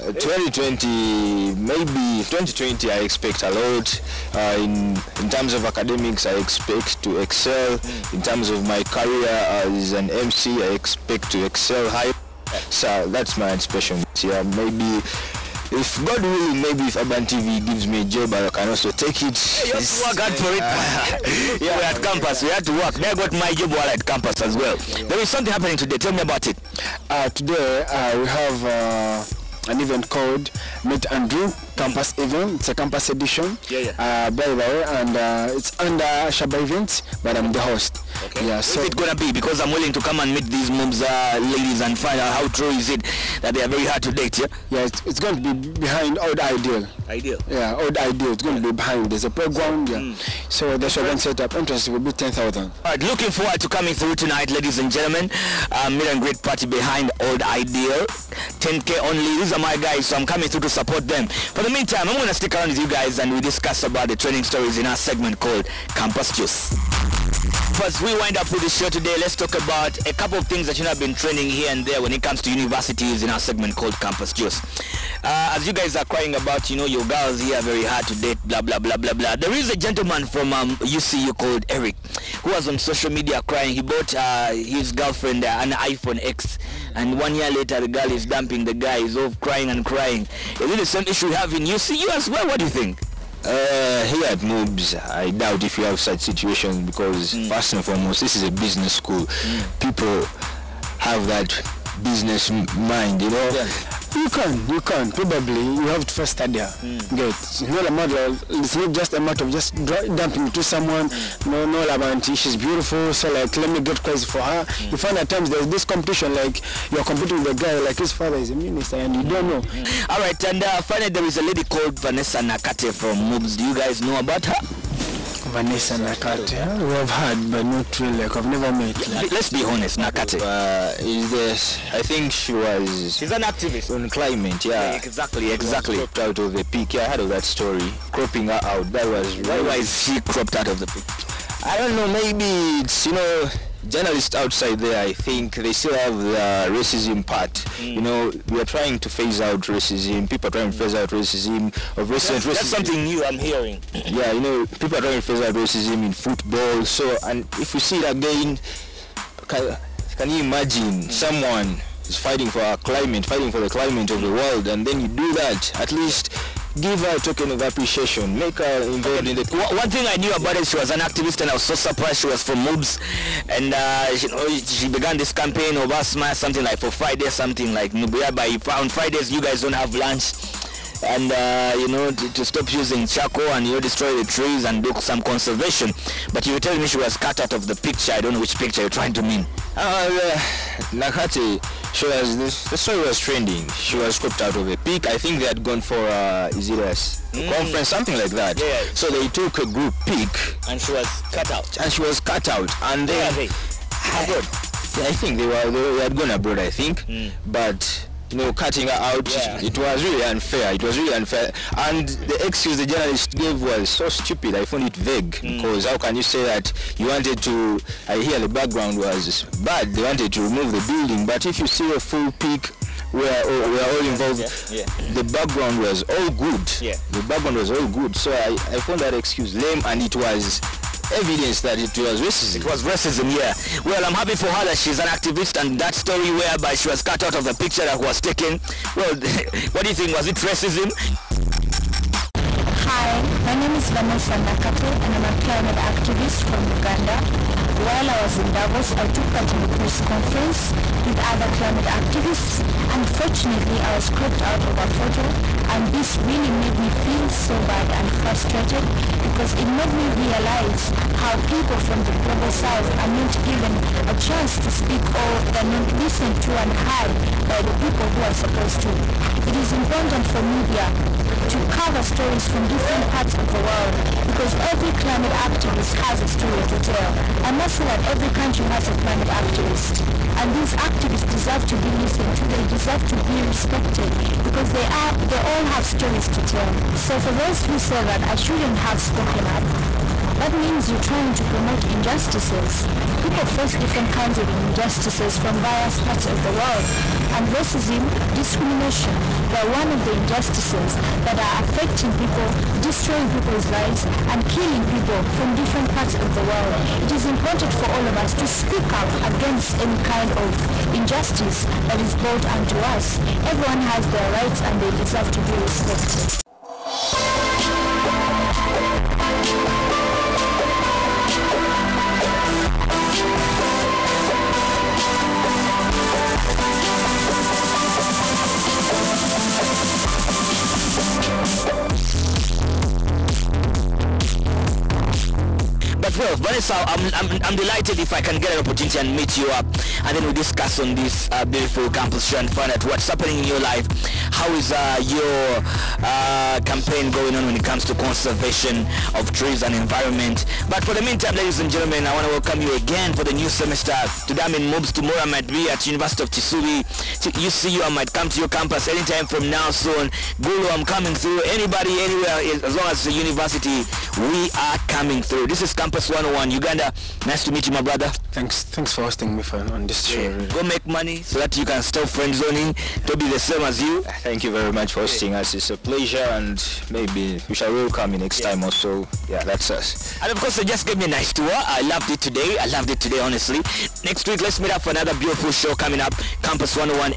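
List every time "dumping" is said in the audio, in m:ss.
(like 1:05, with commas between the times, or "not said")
1:28, 1:50.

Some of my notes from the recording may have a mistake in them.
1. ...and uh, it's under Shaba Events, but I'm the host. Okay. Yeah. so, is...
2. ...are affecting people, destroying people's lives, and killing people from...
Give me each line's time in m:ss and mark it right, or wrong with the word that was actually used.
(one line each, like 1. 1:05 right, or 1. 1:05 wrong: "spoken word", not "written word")
1. 0:34 right
2. 5:01 right.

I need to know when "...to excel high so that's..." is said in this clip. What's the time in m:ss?
0:11.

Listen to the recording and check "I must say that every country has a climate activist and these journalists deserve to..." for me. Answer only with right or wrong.
wrong.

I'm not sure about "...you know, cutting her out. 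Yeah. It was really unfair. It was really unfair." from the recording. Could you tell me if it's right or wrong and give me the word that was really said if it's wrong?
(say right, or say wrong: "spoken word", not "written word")
right.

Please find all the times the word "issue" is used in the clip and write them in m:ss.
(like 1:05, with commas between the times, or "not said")
1:31.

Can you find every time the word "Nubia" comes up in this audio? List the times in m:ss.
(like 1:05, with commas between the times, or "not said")
2:57.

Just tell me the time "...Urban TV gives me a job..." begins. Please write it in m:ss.
0:16.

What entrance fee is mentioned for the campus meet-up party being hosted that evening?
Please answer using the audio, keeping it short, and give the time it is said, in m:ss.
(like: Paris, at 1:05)
10,000, at 0:52.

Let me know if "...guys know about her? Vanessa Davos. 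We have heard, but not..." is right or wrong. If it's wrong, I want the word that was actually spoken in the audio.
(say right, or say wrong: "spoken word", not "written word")
wrong: "Nakate", not "Davos".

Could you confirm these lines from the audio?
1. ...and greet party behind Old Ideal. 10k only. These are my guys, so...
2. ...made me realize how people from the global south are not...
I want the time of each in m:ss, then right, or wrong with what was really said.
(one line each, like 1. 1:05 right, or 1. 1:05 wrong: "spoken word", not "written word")
1. 0:56 right
2. 4:19 right.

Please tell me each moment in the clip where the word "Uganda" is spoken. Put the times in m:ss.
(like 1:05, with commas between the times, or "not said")
4:06, 6:06.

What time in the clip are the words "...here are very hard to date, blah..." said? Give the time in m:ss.
1:17.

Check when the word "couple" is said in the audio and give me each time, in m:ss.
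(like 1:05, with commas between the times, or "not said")
1:10.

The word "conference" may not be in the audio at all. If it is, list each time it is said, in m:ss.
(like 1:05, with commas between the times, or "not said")
3:17, 4:09.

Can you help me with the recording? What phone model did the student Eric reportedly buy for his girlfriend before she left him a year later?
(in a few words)
iPhone X.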